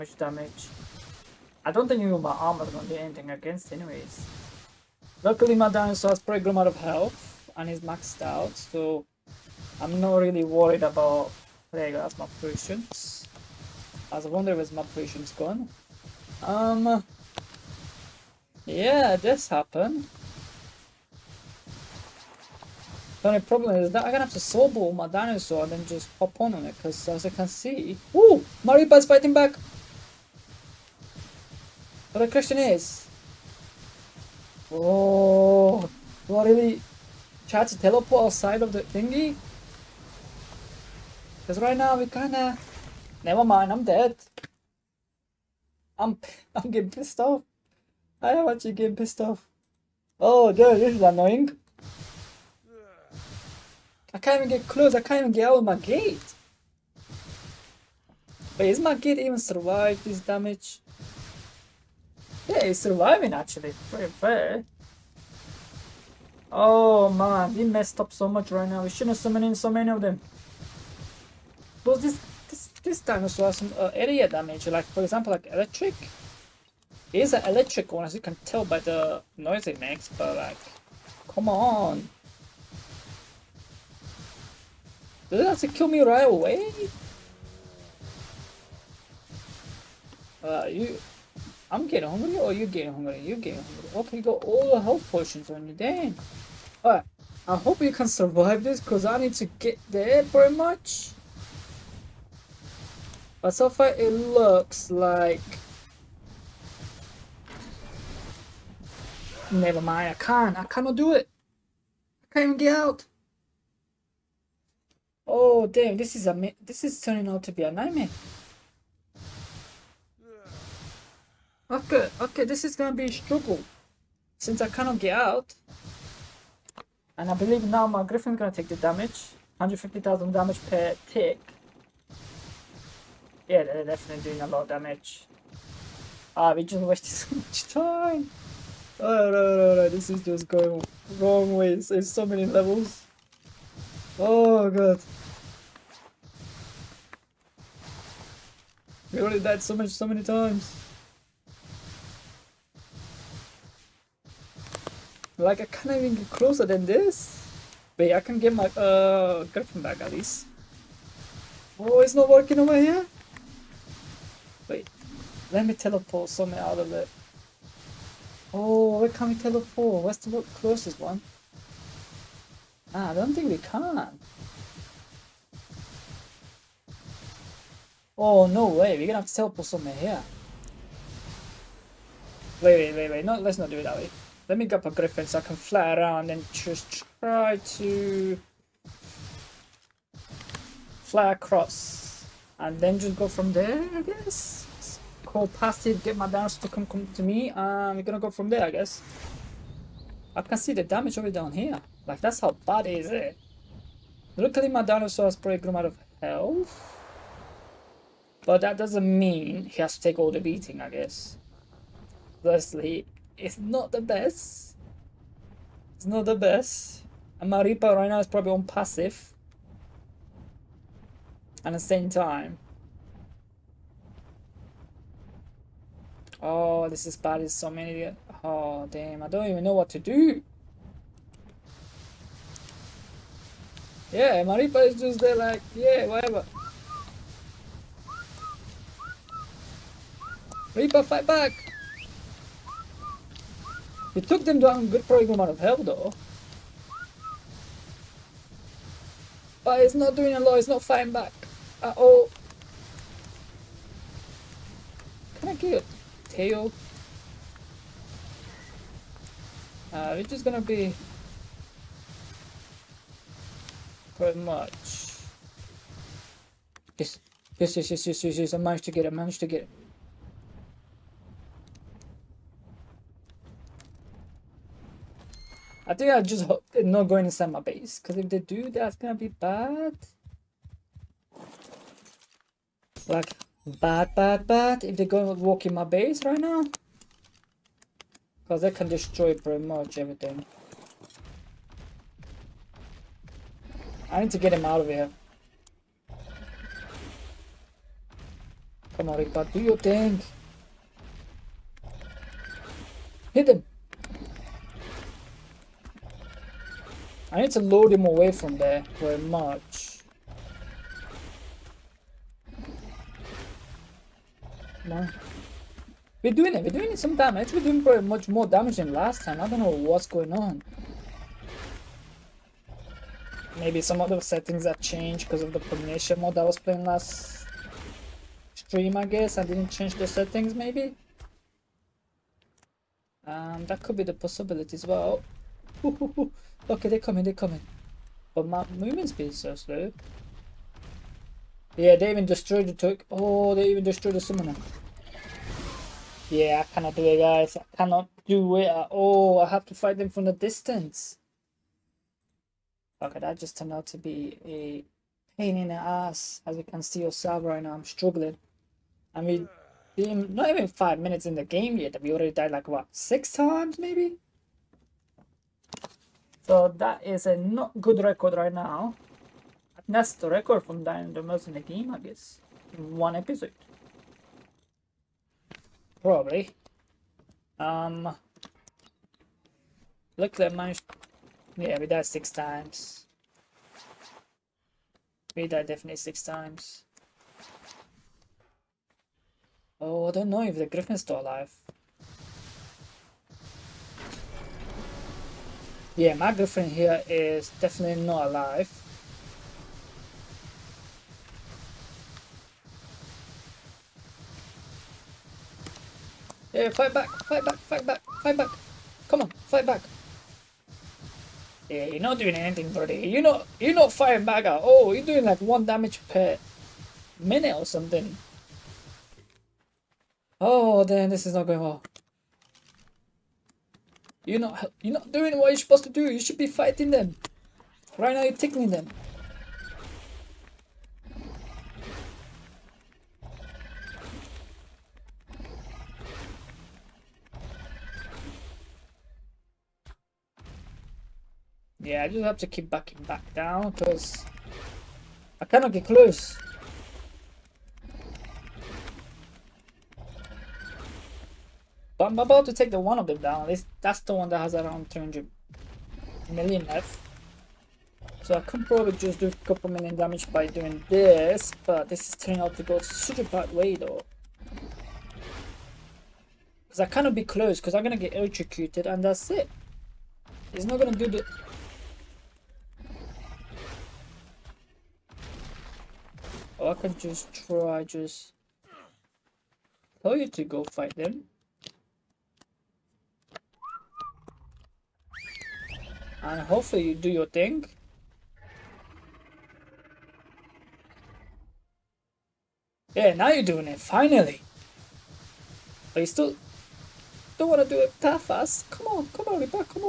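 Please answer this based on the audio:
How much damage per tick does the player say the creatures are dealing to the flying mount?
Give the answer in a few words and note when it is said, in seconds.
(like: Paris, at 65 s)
150,000, at 129 s.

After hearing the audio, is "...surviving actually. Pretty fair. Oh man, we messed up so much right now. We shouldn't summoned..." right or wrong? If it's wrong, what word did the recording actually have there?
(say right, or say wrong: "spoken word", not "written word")
right.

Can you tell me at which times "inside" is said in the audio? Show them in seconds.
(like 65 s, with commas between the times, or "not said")
277 s.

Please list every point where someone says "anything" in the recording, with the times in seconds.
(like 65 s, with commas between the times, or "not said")
2 s, 412 s.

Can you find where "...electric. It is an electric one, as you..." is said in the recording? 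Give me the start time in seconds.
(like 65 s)
75 s.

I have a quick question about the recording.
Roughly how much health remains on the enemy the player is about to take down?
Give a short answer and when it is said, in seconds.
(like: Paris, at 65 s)
300 million, at 454 s.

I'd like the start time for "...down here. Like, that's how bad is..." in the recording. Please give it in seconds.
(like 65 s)
201 s.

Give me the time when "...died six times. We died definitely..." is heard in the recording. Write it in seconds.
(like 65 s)
381 s.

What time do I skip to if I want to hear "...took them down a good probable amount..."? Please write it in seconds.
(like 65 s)
244 s.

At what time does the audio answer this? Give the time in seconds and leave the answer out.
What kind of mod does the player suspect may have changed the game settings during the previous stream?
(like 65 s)
325 s.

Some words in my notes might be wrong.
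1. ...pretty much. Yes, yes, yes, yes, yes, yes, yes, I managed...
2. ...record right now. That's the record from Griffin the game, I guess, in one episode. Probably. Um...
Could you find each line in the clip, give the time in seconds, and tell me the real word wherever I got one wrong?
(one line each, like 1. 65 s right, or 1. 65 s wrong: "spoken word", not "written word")
1. 264 s right
2. 368 s wrong: "Dying", not "Griffin".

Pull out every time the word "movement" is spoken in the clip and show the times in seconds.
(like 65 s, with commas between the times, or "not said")
338 s.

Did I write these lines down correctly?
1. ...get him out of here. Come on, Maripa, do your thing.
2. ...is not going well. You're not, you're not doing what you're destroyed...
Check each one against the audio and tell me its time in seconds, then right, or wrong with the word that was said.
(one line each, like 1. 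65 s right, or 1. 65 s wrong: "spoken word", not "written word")
1. 294 s wrong: "Ripa", not "Maripa"
2. 421 s wrong: "supposed", not "destroyed".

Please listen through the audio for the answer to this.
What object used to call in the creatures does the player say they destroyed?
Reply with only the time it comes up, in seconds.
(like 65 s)
344 s.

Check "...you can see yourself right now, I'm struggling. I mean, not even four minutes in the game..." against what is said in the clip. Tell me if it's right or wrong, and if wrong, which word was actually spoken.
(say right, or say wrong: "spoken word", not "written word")
wrong: "five", not "four".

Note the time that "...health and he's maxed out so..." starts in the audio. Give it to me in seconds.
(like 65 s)
6 s.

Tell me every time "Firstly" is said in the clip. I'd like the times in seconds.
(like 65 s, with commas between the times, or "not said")
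212 s.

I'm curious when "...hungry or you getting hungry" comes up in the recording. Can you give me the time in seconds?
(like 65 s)
92 s.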